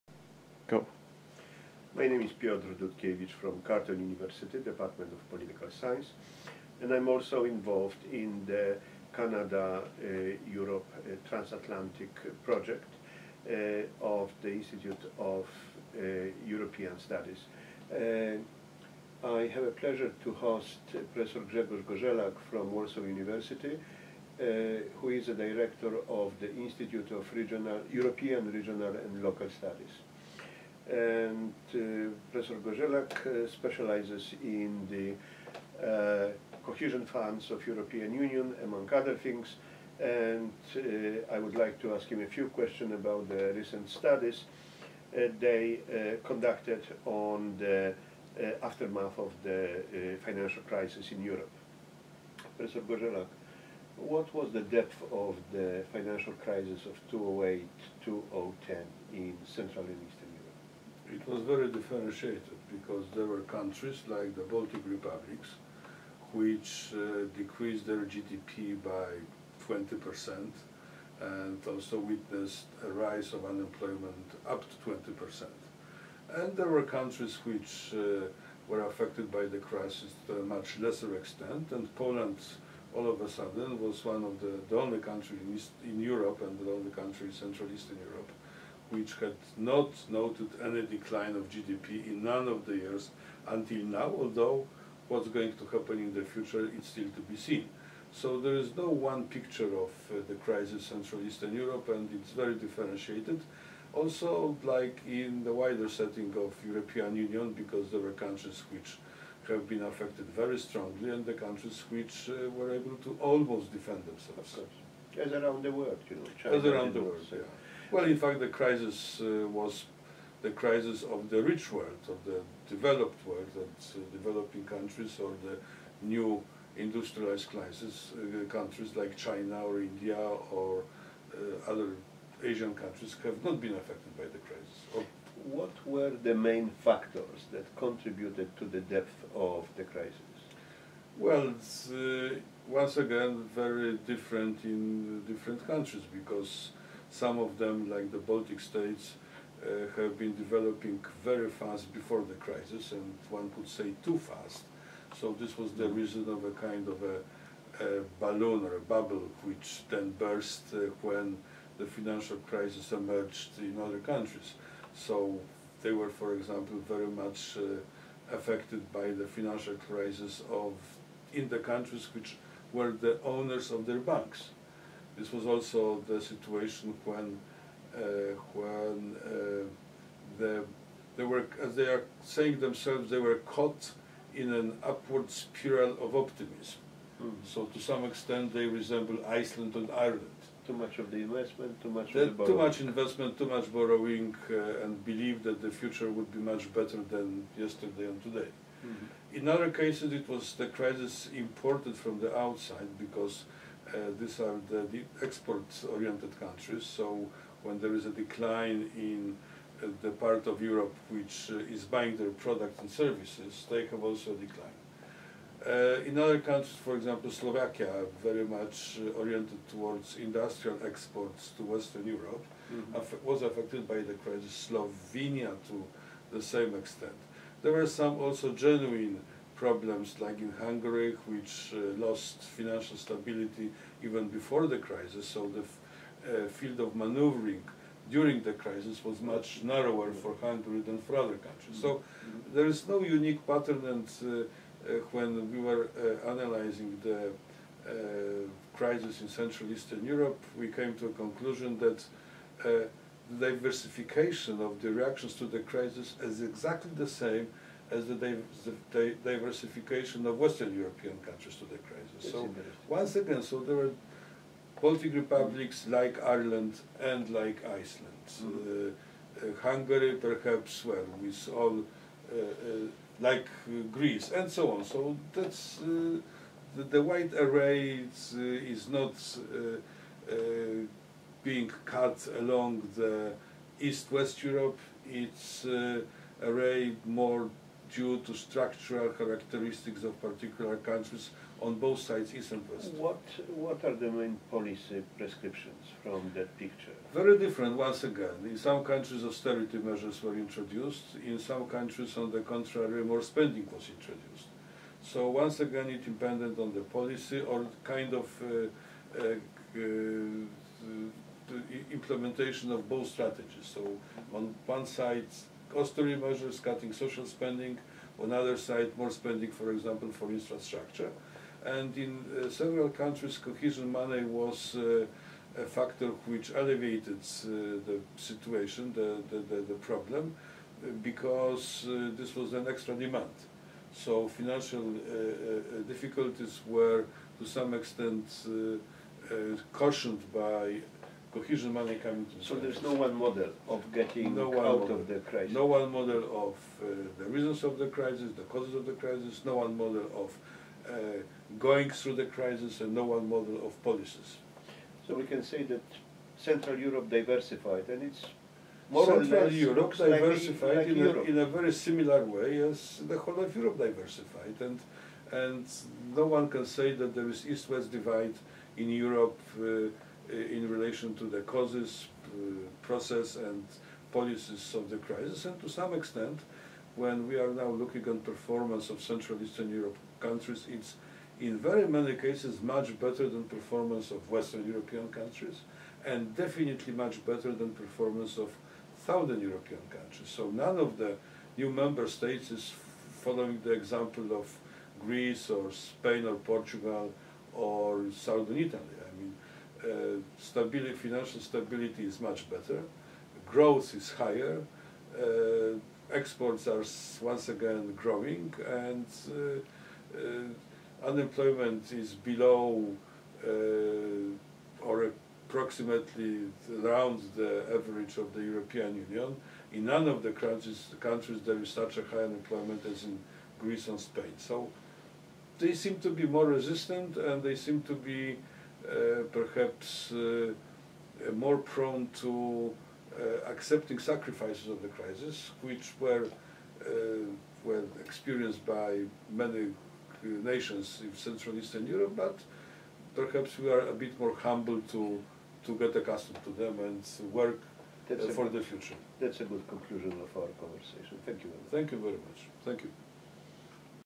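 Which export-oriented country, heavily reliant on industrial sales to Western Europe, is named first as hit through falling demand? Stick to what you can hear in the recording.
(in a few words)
Slovakia.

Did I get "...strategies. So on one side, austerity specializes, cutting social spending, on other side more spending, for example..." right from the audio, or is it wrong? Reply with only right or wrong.
wrong.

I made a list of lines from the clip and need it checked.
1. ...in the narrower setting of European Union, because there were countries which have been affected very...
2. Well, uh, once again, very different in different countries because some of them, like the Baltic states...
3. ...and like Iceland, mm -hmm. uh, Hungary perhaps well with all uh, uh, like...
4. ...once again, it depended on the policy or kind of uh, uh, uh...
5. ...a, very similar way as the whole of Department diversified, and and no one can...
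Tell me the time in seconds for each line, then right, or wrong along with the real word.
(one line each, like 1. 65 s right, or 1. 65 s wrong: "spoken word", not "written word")
1. 105 s wrong: "wider", not "narrower"
2. 141 s right
3. 267 s right
4. 305 s right
5. 361 s wrong: "Europe", not "Department".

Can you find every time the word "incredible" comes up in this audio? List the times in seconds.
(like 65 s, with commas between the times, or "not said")
not said.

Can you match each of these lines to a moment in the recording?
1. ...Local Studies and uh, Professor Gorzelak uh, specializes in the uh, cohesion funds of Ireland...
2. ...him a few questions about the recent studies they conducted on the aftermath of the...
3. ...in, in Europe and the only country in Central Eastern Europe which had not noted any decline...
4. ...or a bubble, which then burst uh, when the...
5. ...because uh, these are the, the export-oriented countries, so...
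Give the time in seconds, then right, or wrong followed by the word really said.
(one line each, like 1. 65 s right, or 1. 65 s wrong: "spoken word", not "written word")
1. 29 s wrong: "European", not "Ireland"
2. 42 s right
3. 85 s right
4. 158 s right
5. 202 s right.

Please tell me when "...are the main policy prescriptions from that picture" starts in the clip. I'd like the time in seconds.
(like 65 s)
293 s.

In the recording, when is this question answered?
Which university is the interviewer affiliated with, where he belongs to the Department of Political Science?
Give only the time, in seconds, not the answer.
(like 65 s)
3 s.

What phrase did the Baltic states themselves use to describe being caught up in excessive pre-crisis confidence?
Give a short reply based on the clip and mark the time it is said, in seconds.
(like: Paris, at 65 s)
upward spiral of optimism, at 184 s.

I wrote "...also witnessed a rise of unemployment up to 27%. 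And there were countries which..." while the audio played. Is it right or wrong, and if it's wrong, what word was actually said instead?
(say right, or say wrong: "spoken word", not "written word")
wrong: "20", not "27".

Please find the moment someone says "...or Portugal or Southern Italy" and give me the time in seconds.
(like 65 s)
396 s.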